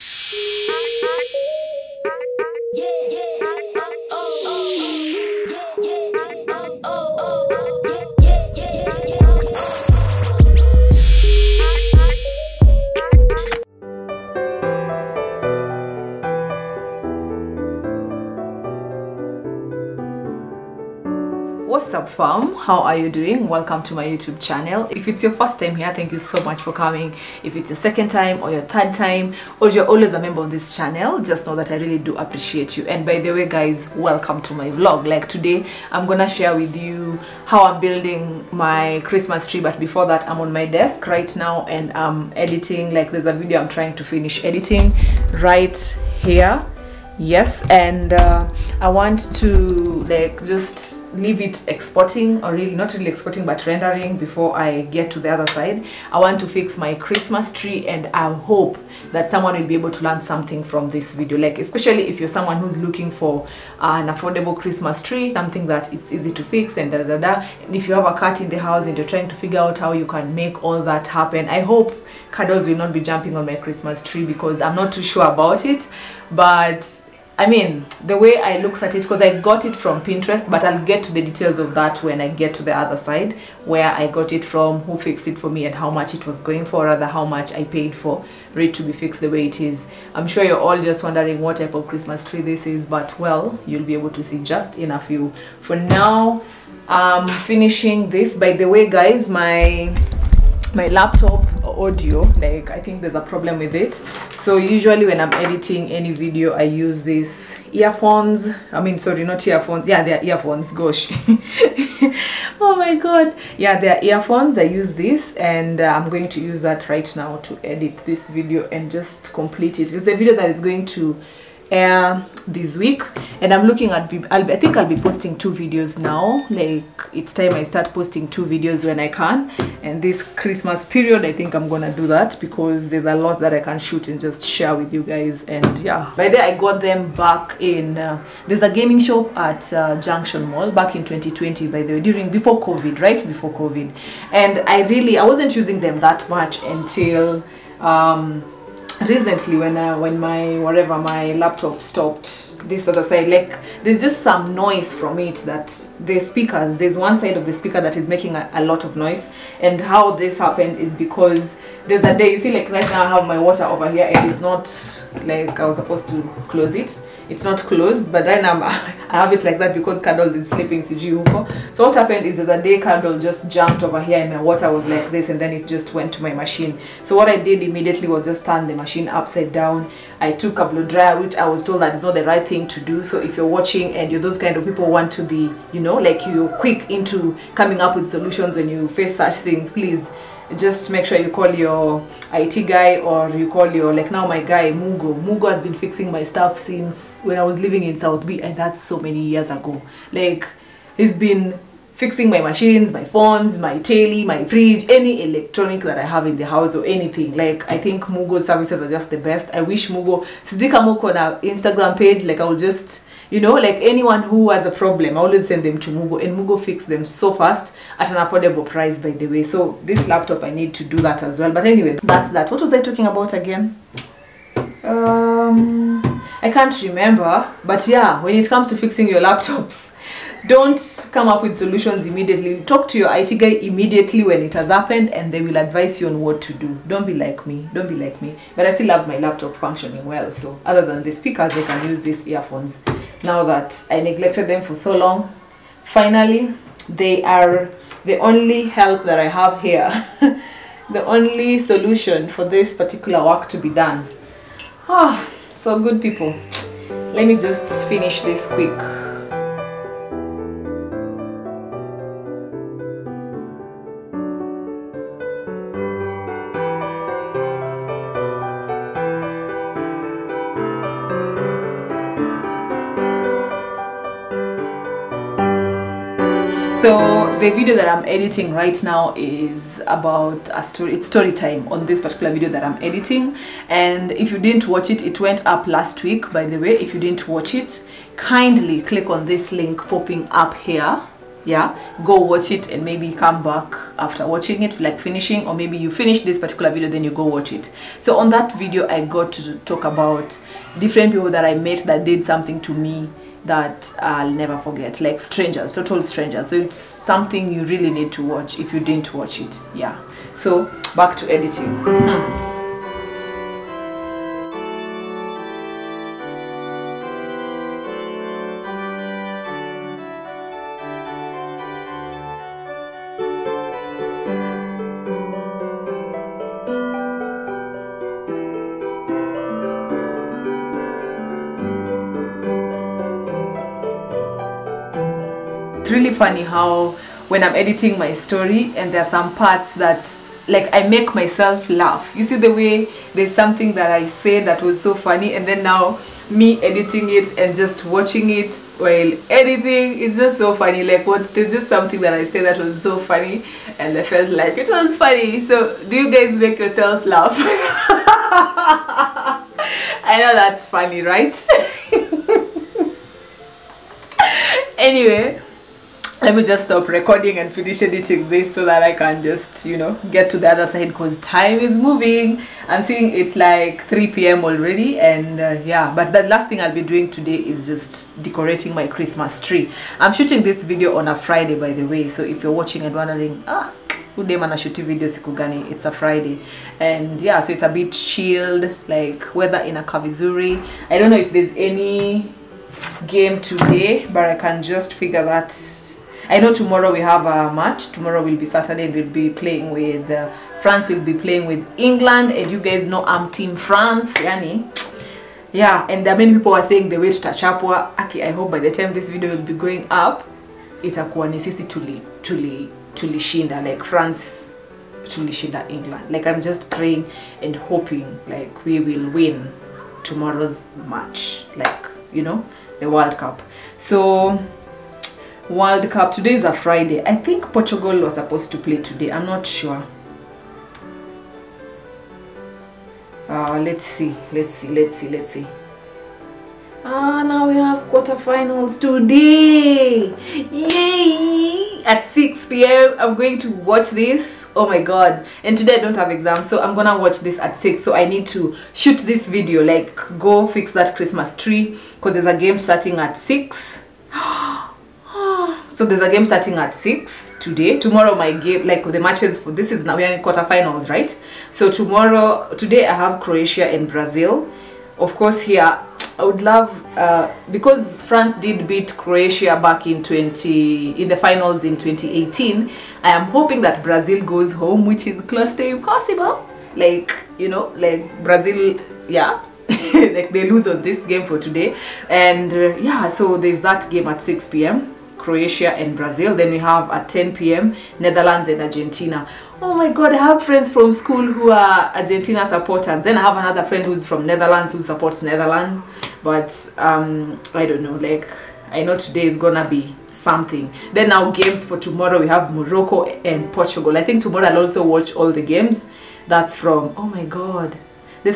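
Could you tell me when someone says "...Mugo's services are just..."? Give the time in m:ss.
3:28.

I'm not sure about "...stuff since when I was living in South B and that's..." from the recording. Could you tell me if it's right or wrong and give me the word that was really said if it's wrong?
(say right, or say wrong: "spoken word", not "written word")
right.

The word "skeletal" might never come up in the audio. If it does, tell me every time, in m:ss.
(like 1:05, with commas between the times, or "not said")
not said.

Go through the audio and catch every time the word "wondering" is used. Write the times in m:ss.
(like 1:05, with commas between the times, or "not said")
1:31, 6:22.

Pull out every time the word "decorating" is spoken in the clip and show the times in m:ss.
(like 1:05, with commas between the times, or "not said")
6:18.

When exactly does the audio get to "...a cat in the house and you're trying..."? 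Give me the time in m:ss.
1:08.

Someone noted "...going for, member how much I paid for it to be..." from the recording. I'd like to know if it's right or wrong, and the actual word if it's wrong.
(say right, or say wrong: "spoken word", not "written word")
wrong: "rather", not "member".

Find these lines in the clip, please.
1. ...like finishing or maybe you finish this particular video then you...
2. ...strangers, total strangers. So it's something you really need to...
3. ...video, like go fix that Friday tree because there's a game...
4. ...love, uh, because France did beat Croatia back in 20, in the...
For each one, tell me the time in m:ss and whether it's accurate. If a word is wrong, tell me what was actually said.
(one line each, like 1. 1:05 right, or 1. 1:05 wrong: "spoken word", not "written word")
1. 4:54 right
2. 5:05 right
3. 7:29 wrong: "Christmas", not "Friday"
4. 7:46 right.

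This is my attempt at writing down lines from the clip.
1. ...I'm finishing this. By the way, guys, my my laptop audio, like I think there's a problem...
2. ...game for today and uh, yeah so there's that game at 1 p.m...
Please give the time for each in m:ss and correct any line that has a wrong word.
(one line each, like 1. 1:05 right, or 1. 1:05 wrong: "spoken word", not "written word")
1. 1:36 right
2. 8:01 wrong: "6", not "1".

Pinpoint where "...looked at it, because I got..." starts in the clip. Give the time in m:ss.
1:18.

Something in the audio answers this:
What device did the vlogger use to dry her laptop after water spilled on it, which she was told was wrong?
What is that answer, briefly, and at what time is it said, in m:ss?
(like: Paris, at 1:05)
A blow dryer, at 3:00.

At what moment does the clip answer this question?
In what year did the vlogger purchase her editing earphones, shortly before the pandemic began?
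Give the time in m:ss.
2:21.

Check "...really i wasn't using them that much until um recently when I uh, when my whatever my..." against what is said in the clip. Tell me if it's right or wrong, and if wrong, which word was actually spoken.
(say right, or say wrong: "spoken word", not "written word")
right.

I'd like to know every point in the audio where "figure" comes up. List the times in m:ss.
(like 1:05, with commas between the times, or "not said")
1:09, 6:34.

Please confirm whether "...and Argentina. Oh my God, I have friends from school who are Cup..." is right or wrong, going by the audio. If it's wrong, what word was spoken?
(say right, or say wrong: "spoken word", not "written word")
wrong: "Argentina", not "Cup".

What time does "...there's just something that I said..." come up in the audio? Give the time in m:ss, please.
5:51.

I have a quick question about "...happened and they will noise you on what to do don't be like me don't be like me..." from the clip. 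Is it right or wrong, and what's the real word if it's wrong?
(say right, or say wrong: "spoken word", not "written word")
wrong: "advise", not "noise".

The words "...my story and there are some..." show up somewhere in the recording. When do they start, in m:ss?
5:37.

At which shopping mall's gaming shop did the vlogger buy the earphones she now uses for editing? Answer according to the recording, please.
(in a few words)
Junction Mall.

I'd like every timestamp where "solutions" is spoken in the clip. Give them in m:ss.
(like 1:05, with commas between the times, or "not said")
3:08, 3:51, 4:11.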